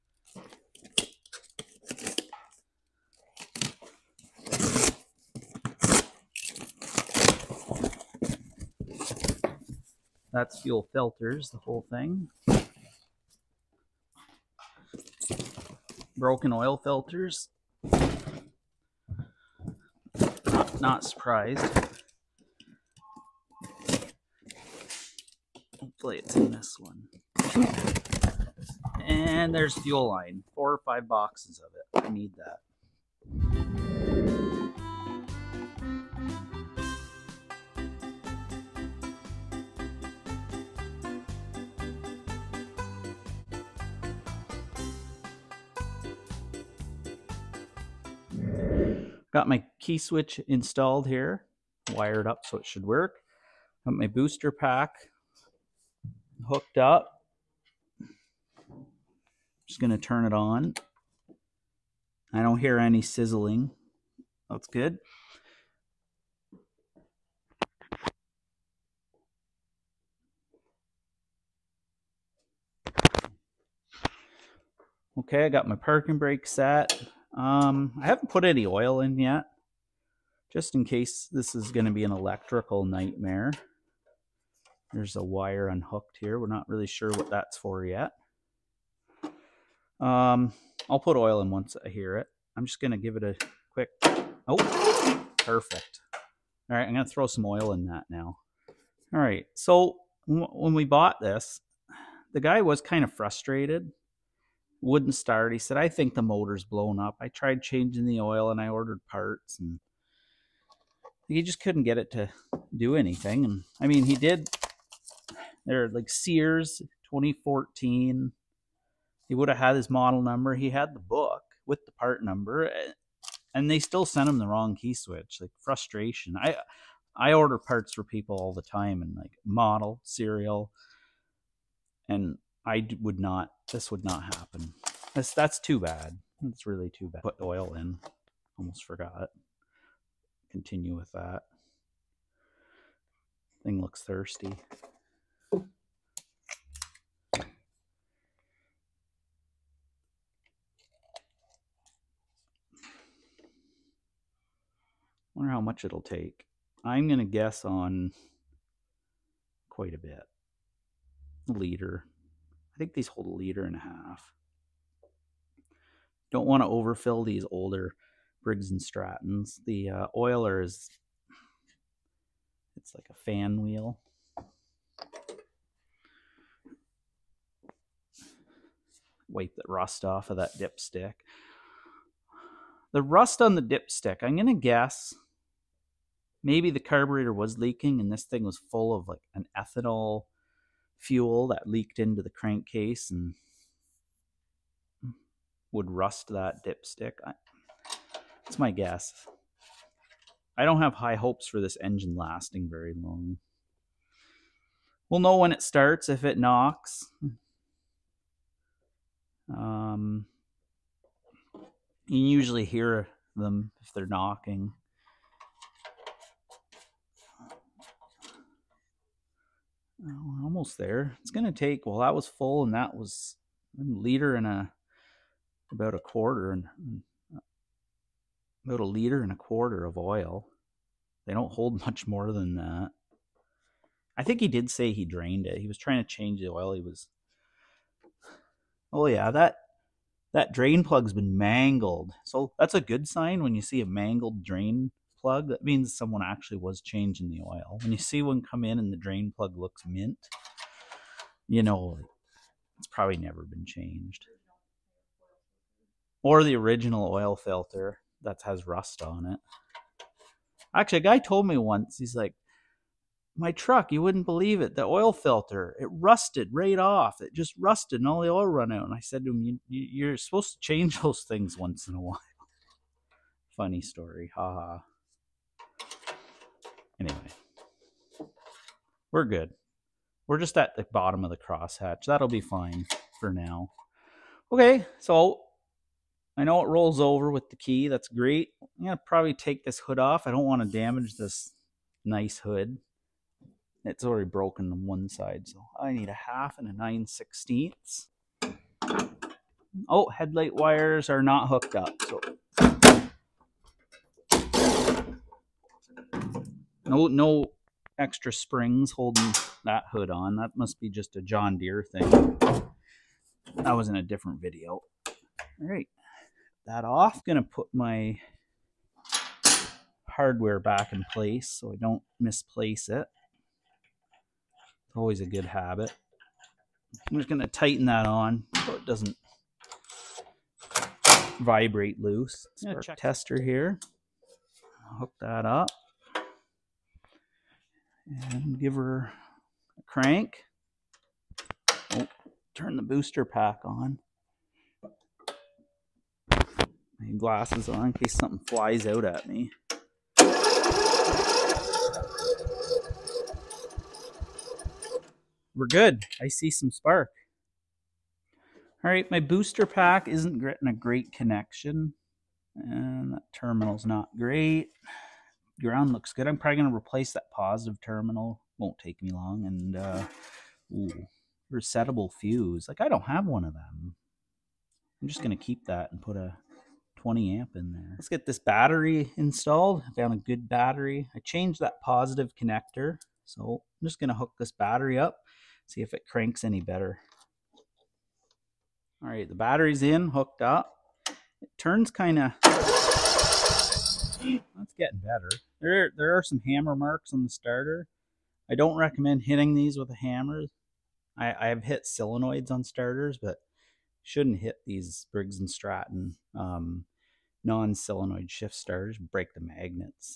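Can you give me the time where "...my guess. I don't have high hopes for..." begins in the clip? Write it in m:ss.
3:18.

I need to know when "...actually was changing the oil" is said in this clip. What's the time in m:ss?
4:06.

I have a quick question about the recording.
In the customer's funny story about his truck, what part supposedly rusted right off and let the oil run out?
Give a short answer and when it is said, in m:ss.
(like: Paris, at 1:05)
The oil filter, at 4:24.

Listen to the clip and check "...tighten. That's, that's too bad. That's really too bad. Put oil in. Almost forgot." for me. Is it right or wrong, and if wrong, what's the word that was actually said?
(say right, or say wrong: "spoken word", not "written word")
wrong: "happen", not "tighten".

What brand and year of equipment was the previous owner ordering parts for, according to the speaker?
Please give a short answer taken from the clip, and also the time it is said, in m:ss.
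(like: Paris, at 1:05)
Sears 2014, at 1:56.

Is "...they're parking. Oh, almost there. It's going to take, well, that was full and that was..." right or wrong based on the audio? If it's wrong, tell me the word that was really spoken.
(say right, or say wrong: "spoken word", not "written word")
wrong: "knocking", not "parking".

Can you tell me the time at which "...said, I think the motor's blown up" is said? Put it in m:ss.
1:45.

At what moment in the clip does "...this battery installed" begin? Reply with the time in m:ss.
6:18.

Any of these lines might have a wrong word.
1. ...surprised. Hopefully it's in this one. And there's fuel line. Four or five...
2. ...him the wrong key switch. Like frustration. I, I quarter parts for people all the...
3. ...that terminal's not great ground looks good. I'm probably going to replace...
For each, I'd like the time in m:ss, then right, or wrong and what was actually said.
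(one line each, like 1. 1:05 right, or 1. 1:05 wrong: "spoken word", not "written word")
1. 0:21 right
2. 2:04 wrong: "order", not "quarter"
3. 6:03 right.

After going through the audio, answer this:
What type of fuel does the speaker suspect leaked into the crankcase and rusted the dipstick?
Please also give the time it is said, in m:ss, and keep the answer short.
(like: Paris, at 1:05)
ethanol fuel, at 3:09.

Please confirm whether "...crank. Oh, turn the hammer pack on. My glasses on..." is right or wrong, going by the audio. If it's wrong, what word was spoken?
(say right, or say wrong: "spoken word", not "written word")
wrong: "booster", not "hammer".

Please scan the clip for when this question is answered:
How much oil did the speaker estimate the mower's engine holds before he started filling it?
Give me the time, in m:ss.
2:43.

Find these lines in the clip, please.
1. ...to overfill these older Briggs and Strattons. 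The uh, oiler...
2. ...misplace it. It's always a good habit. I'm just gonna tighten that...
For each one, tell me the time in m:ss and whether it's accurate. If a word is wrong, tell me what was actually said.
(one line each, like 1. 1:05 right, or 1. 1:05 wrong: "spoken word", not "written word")
1. 2:46 right
2. 5:22 right.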